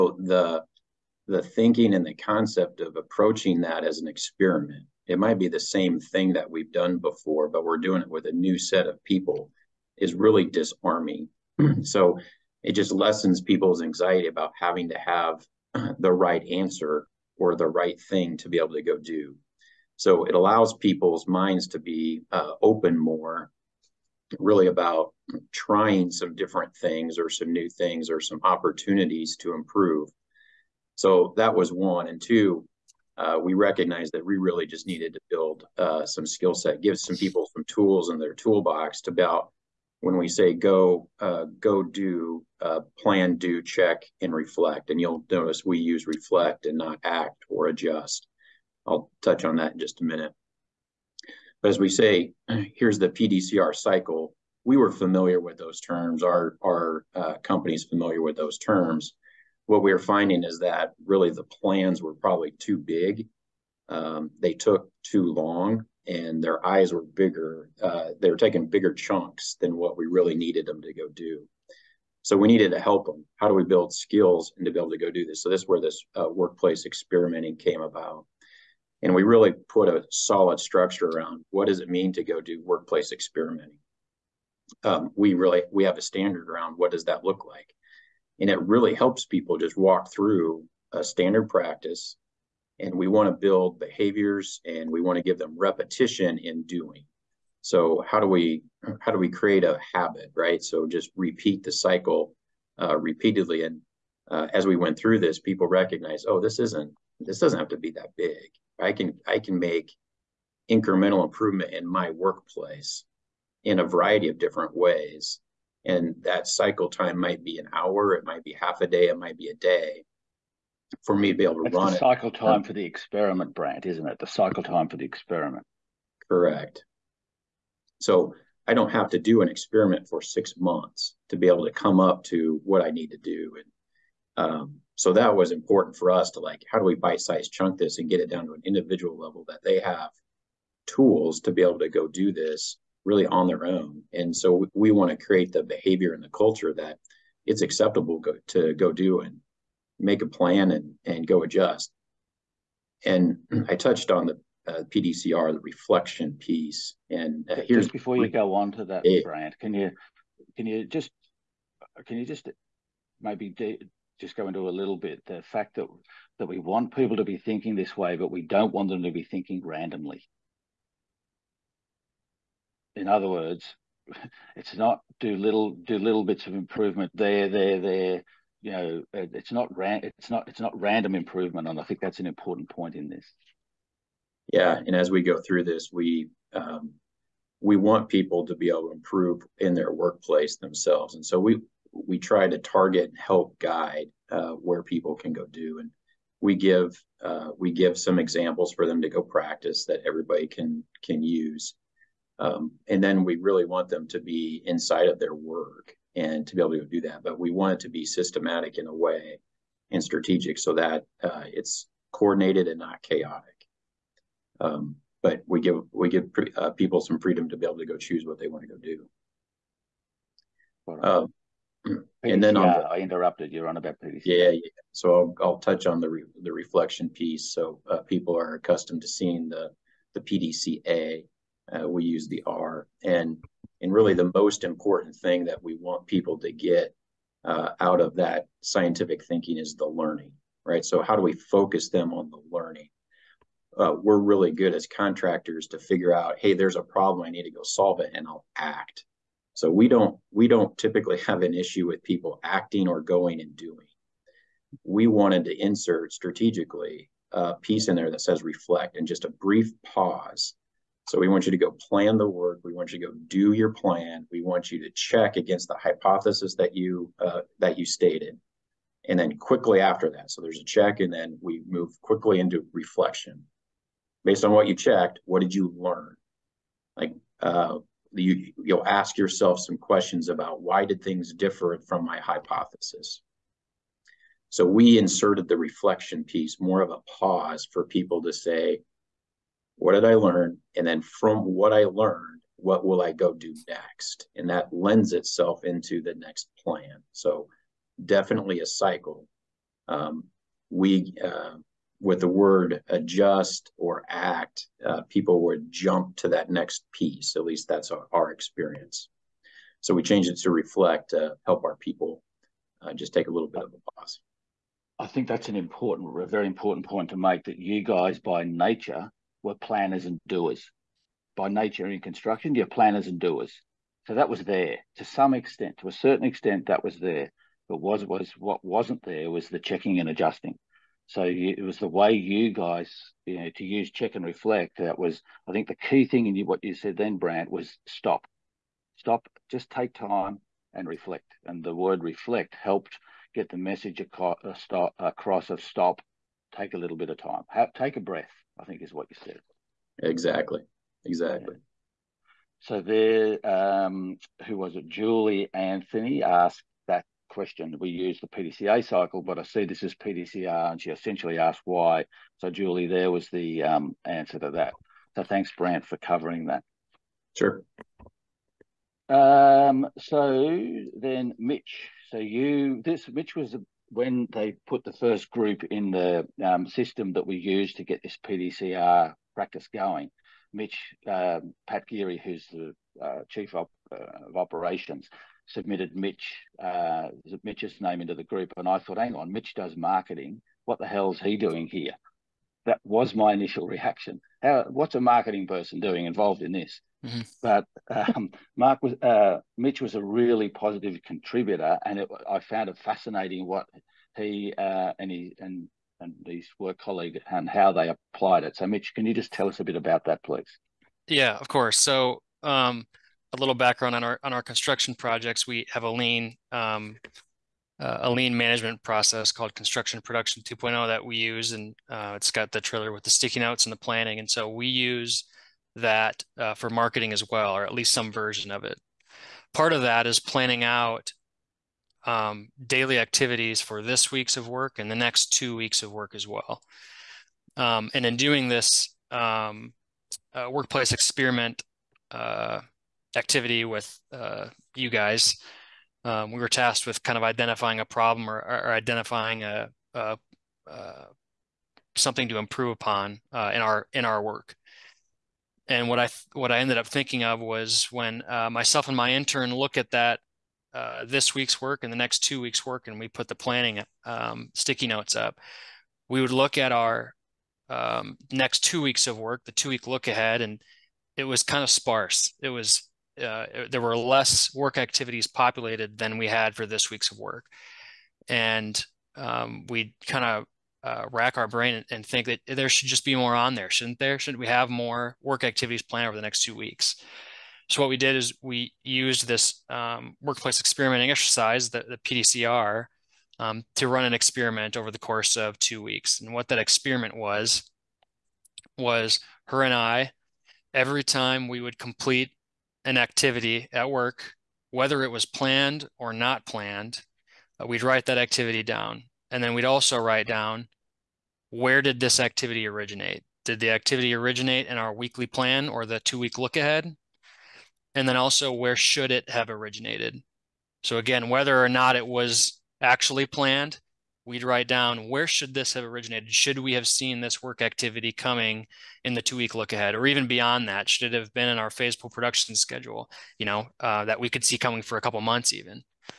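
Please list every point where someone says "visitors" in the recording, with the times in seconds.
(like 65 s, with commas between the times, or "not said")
not said.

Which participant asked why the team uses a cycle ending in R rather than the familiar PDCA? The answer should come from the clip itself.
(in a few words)
Julie Anthony.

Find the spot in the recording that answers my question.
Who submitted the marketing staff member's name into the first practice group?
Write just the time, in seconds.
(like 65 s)
381 s.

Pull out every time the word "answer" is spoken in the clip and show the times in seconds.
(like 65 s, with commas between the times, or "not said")
16 s, 364 s.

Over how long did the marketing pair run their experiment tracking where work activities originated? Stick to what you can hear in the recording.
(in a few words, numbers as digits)
2 weeks.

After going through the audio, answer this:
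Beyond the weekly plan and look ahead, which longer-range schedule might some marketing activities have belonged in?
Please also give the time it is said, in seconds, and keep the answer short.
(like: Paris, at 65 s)
Phase pull production schedule, at 531 s.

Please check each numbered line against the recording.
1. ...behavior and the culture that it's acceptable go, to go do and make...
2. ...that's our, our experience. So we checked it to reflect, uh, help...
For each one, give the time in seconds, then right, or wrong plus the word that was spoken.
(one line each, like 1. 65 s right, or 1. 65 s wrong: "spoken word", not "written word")
1. 145 s right
2. 307 s wrong: "changed", not "checked".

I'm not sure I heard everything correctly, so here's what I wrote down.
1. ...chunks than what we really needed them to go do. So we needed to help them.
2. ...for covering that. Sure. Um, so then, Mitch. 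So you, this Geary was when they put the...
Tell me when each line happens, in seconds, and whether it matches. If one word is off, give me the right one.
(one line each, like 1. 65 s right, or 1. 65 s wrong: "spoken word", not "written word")
1. 68 s right
2. 365 s wrong: "Mitch", not "Geary".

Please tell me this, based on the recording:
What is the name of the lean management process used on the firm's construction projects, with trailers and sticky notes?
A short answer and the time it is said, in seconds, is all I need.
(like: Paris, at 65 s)
Construction Production 2.0, at 419 s.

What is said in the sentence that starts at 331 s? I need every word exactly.
So you, it was the way you guys, you know, to use check and reflect.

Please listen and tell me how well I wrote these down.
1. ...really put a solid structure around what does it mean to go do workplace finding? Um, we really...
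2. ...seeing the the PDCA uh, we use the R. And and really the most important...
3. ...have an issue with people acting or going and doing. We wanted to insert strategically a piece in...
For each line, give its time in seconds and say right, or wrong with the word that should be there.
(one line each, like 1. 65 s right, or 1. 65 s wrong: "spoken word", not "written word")
1. 79 s wrong: "experimenting", not "finding"
2. 229 s right
3. 251 s right.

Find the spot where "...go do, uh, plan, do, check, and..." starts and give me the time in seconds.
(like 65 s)
41 s.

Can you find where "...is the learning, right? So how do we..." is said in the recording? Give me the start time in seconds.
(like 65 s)
239 s.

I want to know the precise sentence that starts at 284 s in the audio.
So we inserted the reflection piece, more of a pause for people to say, what did I learn?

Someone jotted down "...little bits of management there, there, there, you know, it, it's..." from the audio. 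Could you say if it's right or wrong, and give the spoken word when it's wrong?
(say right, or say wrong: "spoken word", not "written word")
wrong: "improvement", not "management".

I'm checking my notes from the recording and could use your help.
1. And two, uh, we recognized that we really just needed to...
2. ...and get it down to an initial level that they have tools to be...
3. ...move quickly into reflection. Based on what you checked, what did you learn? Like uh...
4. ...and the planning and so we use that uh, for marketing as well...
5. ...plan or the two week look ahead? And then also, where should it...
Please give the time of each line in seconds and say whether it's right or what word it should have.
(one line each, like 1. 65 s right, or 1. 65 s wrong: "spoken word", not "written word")
1. 32 s right
2. 137 s wrong: "individual", not "initial"
3. 271 s right
4. 423 s right
5. 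515 s right.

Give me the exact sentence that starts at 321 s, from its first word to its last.
By nature in construction, you're planners and doers.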